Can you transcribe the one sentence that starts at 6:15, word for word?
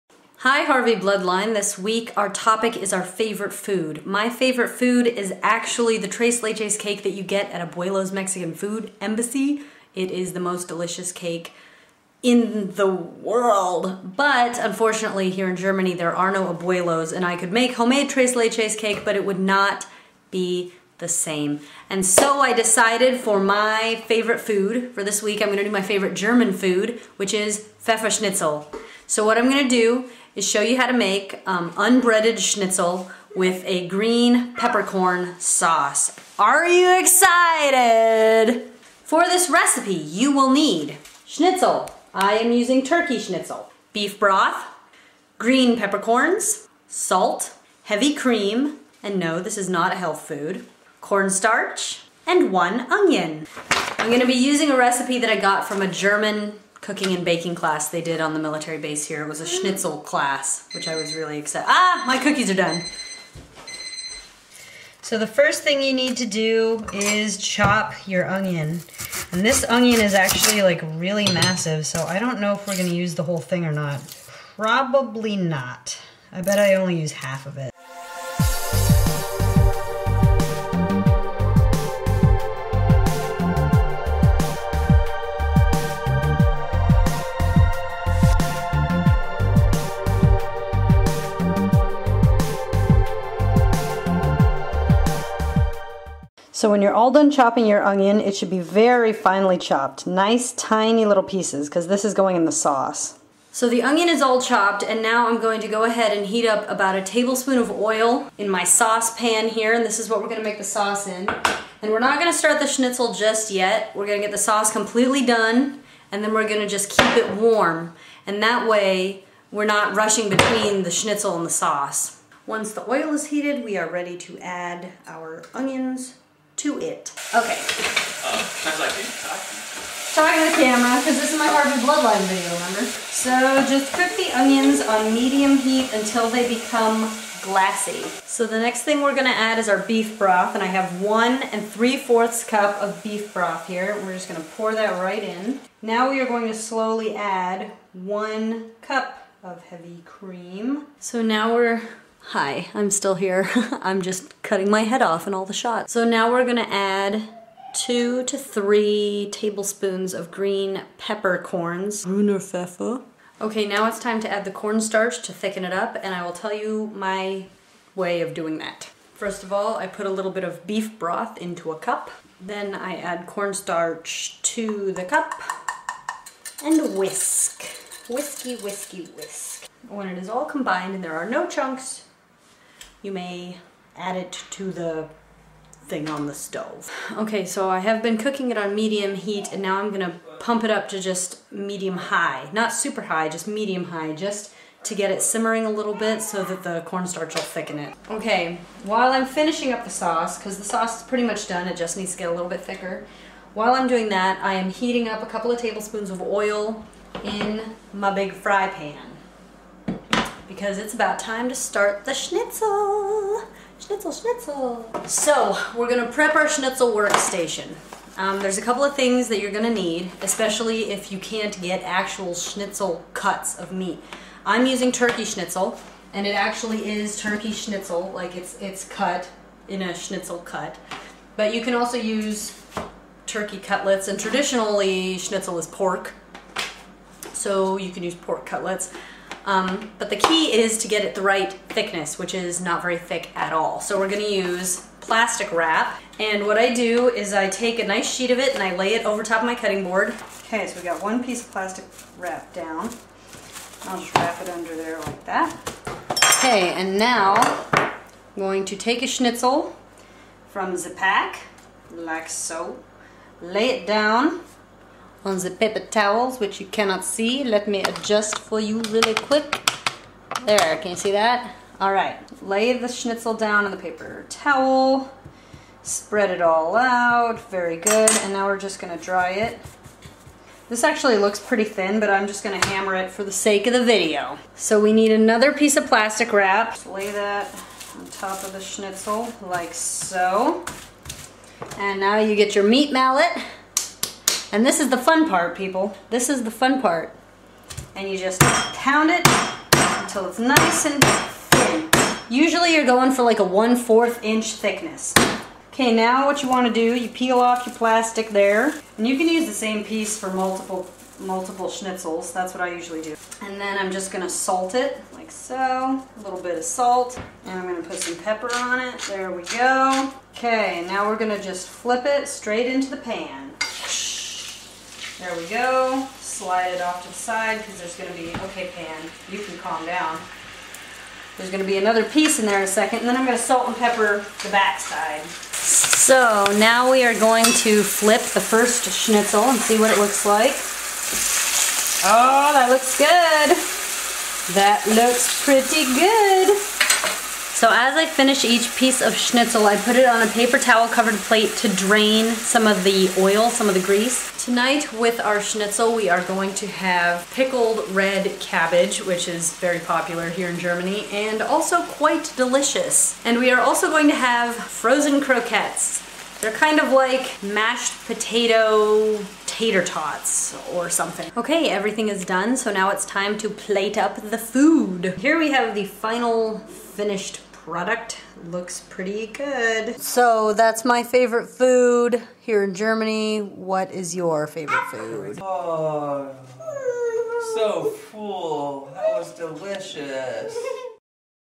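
Here we have the final finished product looks pretty good.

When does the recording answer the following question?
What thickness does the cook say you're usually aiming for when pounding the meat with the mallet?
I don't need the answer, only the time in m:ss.
5:03.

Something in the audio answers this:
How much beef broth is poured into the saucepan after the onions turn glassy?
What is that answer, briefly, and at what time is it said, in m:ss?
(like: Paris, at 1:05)
1 3/4 cups, at 2:21.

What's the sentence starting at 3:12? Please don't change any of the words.
Not super high, just medium high, just to get it simmering a little bit so that the cornstarch will thicken it.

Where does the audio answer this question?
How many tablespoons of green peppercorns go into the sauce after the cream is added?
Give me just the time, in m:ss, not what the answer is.
2:37.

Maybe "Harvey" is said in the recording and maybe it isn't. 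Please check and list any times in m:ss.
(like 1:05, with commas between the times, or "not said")
0:00, 2:11.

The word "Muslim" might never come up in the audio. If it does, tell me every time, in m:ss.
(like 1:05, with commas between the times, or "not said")
not said.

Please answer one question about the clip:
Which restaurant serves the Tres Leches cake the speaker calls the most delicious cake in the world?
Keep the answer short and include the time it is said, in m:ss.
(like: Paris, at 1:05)
Abuelo's Mexican Food Embassy, at 0:07.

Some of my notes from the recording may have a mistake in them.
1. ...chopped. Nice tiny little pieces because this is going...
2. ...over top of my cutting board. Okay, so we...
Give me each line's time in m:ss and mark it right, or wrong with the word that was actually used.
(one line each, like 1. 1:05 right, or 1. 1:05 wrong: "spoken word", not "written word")
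1. 1:39 right
2. 4:09 right.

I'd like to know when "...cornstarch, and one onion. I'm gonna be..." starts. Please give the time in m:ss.
0:51.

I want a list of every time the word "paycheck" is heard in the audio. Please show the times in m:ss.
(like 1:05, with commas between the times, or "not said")
not said.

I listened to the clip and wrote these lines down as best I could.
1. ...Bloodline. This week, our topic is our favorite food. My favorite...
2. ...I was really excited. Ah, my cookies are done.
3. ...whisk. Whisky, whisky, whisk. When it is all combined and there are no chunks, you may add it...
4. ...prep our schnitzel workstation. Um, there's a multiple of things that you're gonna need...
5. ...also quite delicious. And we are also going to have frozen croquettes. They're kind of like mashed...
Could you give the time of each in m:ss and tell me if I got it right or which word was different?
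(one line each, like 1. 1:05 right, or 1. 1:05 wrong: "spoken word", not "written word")
1. 0:00 right
2. 1:00 right
3. 2:56 right
4. 3:36 wrong: "couple", not "multiple"
5. 6:01 right.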